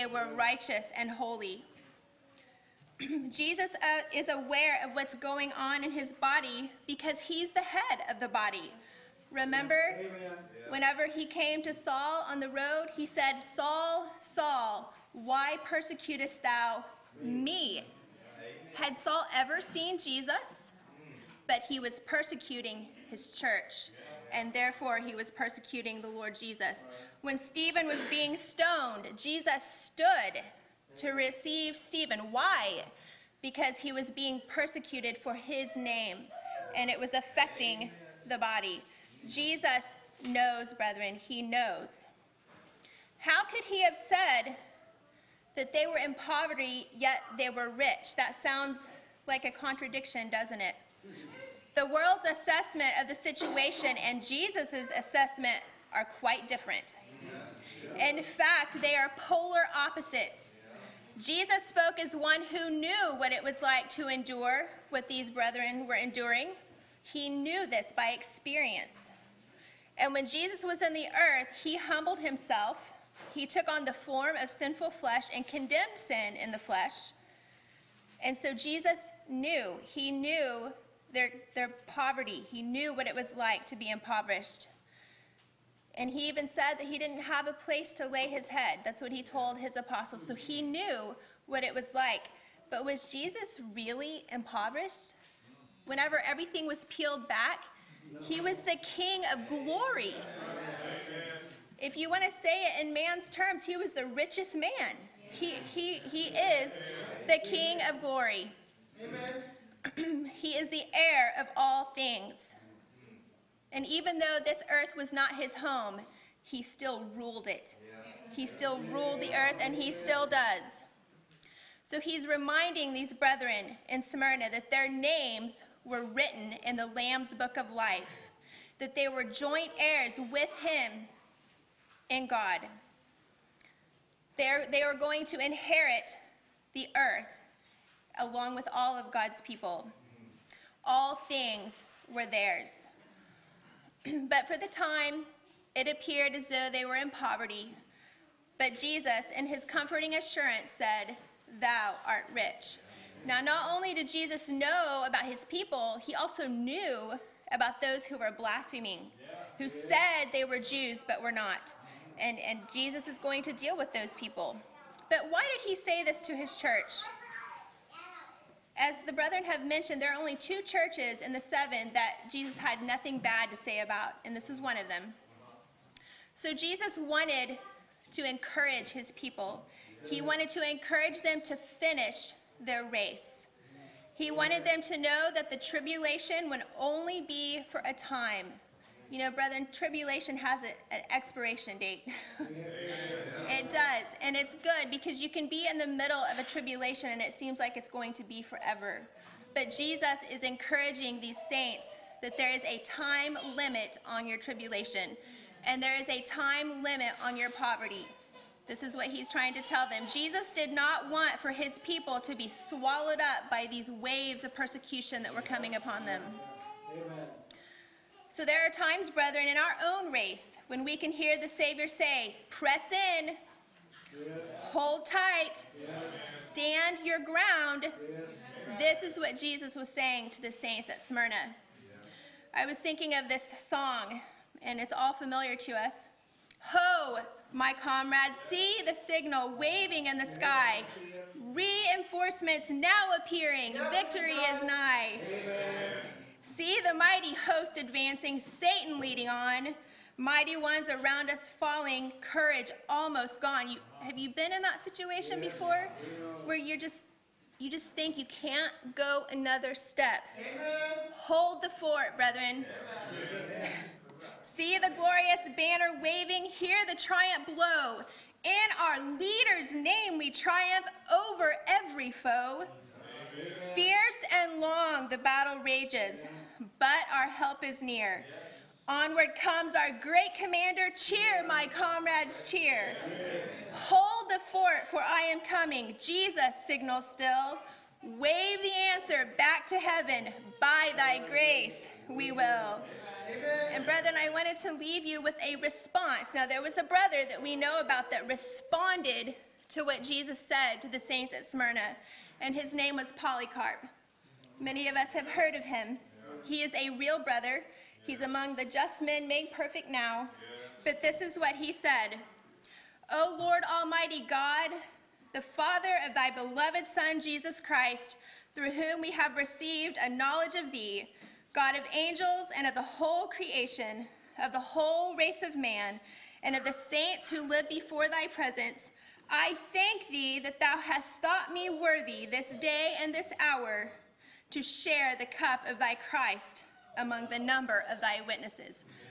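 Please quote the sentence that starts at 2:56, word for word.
So Jesus wanted to encourage his people.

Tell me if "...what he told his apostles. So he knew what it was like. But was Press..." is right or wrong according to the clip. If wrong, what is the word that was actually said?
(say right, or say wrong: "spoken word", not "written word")
wrong: "Jesus", not "Press".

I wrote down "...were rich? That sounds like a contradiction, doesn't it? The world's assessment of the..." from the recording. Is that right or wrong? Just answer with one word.
right.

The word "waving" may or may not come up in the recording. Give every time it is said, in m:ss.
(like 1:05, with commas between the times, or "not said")
3:59, 4:26.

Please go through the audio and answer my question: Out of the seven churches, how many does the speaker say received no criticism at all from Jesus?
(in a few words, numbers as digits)
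2.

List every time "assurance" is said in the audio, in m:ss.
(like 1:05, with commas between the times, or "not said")
2:30.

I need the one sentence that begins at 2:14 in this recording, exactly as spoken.
They're, they are going to inherit the earth along with all of God's people.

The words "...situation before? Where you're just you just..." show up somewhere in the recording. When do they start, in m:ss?
4:14.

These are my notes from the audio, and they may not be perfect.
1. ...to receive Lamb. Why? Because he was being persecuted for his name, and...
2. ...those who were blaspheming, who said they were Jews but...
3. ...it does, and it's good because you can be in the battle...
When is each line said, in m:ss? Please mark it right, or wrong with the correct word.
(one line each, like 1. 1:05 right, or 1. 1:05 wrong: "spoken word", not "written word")
1. 0:30 wrong: "Stephen", not "Lamb"
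2. 2:37 right
3. 3:12 wrong: "middle", not "battle".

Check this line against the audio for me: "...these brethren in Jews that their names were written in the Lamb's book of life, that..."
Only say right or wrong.
wrong.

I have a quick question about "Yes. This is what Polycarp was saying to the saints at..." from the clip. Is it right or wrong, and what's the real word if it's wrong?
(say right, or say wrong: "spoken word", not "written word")
wrong: "Jesus", not "Polycarp".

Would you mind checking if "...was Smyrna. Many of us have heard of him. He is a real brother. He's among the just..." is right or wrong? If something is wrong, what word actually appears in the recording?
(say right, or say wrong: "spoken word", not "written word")
wrong: "Polycarp", not "Smyrna".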